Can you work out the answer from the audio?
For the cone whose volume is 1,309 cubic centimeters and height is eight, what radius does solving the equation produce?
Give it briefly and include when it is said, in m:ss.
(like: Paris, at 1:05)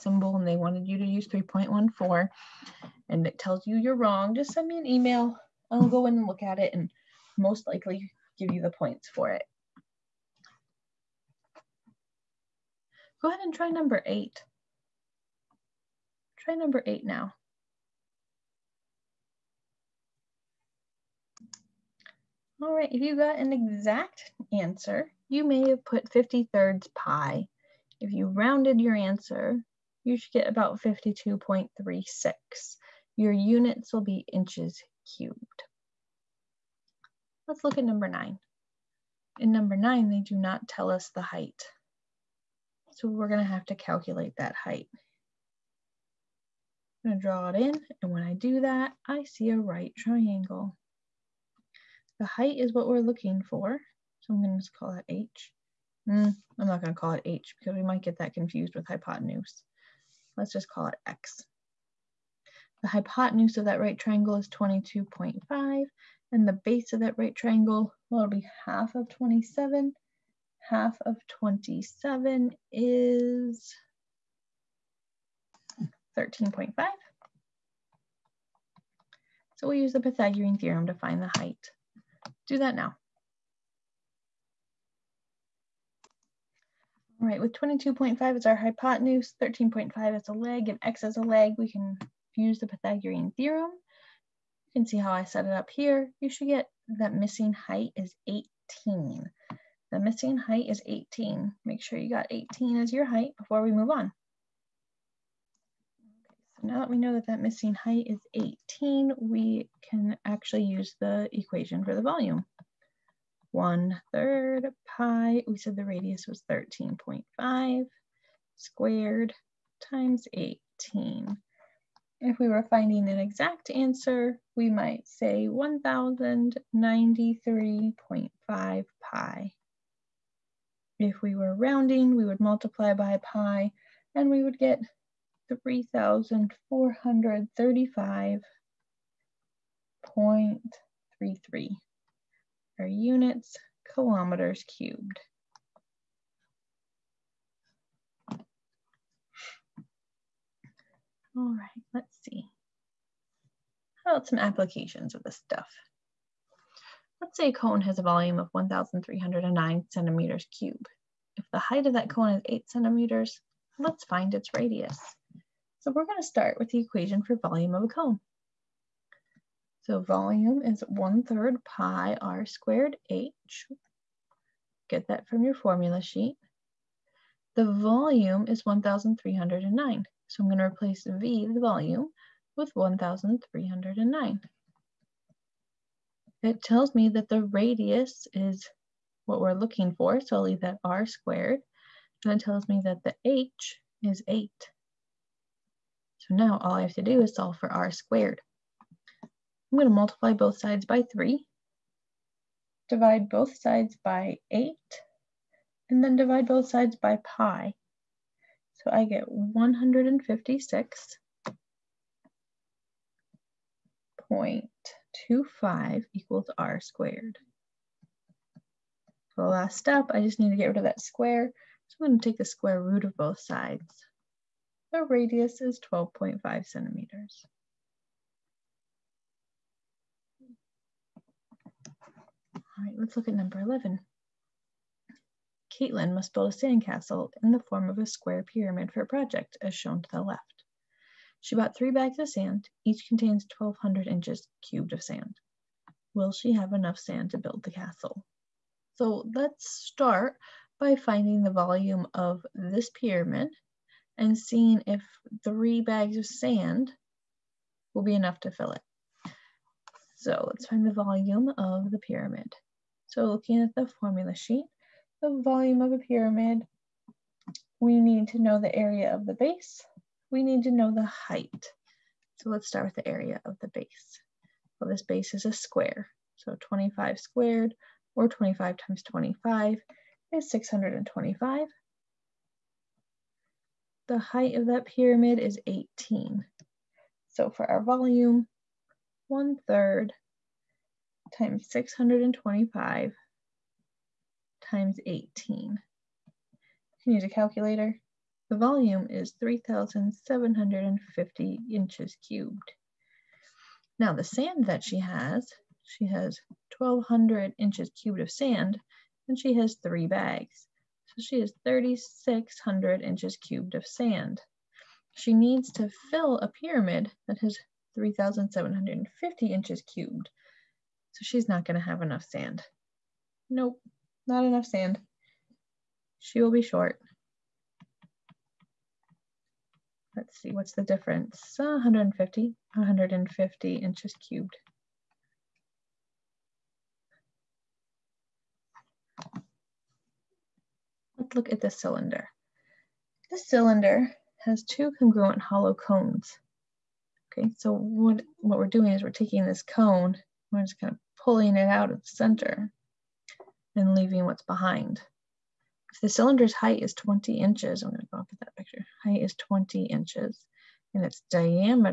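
12.5 centimeters, at 3:45.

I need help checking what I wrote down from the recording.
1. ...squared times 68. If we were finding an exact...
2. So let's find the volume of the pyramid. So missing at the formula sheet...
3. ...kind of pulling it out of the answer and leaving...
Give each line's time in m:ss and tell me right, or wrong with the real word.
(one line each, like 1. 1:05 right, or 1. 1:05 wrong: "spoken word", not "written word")
1. 1:58 wrong: "18", not "68"
2. 4:20 wrong: "looking", not "missing"
3. 5:50 wrong: "center", not "answer".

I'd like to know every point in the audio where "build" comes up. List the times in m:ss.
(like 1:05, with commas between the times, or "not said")
3:56, 4:07.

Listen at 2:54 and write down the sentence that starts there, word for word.
Get that from your formula sheet.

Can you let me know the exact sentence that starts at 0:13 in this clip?
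Go ahead and try number eight.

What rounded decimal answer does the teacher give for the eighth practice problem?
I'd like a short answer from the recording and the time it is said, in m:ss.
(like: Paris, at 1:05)
52.36, at 0:30.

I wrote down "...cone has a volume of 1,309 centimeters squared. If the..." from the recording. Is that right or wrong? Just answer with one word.
wrong.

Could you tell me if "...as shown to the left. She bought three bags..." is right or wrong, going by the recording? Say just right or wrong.
right.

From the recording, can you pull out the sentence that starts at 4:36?
So 25 squared or 25 times 25 is 625.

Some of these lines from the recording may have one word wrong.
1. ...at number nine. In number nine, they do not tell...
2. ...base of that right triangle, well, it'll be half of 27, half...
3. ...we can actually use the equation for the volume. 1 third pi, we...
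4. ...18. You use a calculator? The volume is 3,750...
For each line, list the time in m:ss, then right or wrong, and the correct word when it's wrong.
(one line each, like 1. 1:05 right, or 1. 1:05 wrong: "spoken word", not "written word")
1. 0:37 right
2. 1:06 right
3. 1:49 right
4. 4:55 right.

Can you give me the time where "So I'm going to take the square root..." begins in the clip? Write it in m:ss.
3:41.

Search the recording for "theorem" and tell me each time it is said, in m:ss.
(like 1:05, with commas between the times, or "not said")
1:20, 1:33.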